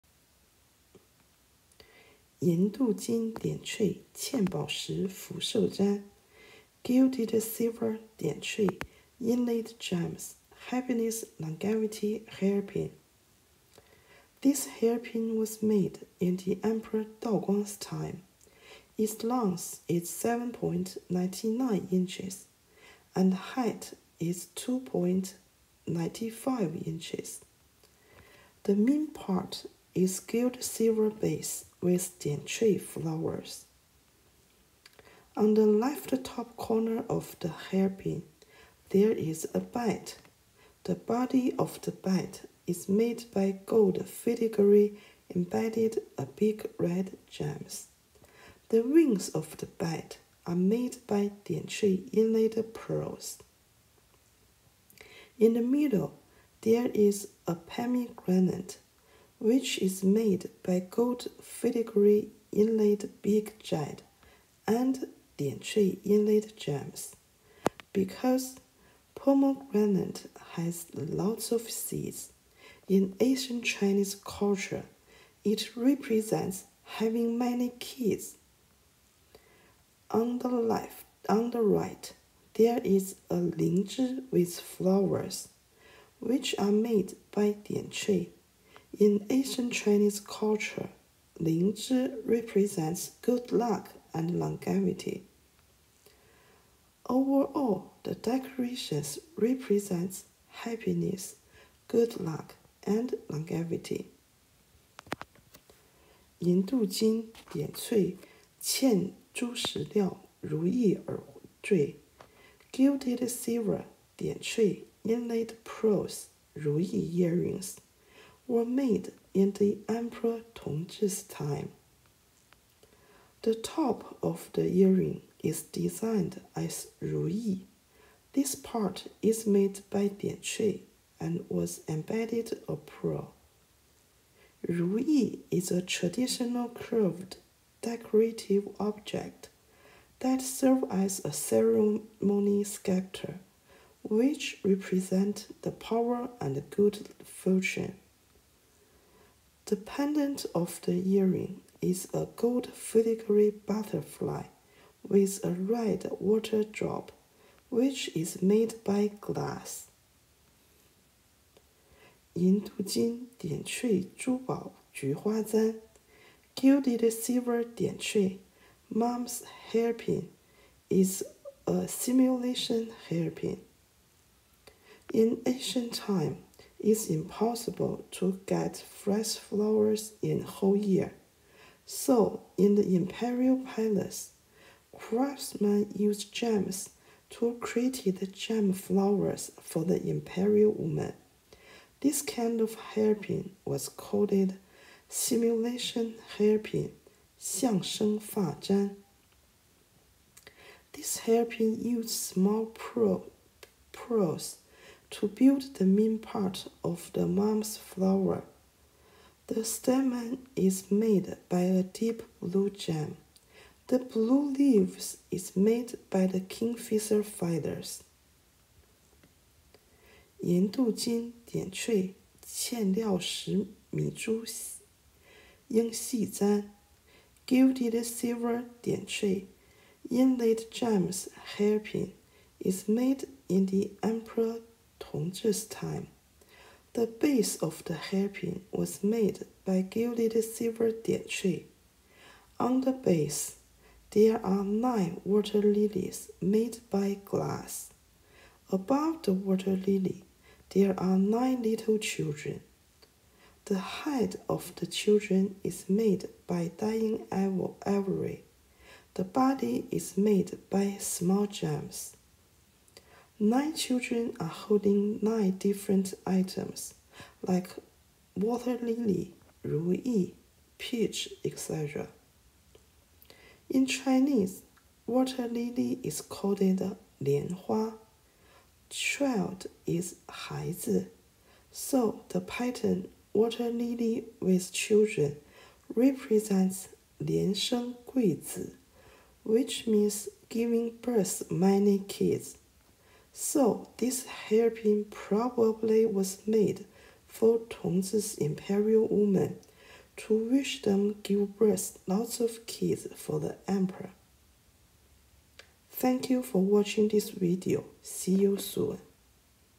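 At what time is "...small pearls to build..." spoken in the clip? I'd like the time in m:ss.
3:22.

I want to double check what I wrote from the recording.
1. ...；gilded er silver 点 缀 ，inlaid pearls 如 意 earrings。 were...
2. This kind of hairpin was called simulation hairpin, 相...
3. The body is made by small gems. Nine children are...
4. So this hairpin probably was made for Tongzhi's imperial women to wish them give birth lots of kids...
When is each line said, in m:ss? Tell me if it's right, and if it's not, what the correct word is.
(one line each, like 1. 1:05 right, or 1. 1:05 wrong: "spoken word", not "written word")
1. 1:52 right
2. 3:11 right
3. 4:19 right
4. 4:53 right.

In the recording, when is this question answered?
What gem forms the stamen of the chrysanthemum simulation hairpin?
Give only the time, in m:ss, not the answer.
3:31.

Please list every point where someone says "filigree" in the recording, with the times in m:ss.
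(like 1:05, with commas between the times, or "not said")
0:44, 1:01, 2:32.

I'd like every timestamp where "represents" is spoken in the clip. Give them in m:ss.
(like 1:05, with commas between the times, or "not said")
1:15, 1:32, 1:39, 2:24, 4:45.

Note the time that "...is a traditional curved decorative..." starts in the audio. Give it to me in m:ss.
2:15.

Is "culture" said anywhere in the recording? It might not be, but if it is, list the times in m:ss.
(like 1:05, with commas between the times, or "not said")
1:14, 1:30.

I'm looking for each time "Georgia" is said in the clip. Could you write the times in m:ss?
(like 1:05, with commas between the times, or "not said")
not said.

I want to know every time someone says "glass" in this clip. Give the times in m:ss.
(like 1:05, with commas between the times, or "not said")
2:39, 4:07.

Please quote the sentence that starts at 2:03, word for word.
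The top of the earring is designed as Ruyi.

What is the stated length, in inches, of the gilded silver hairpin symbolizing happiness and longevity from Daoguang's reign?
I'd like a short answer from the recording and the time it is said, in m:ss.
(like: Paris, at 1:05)
7.99 inches, at 0:20.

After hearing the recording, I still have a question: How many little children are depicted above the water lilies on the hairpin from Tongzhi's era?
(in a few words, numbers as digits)
9.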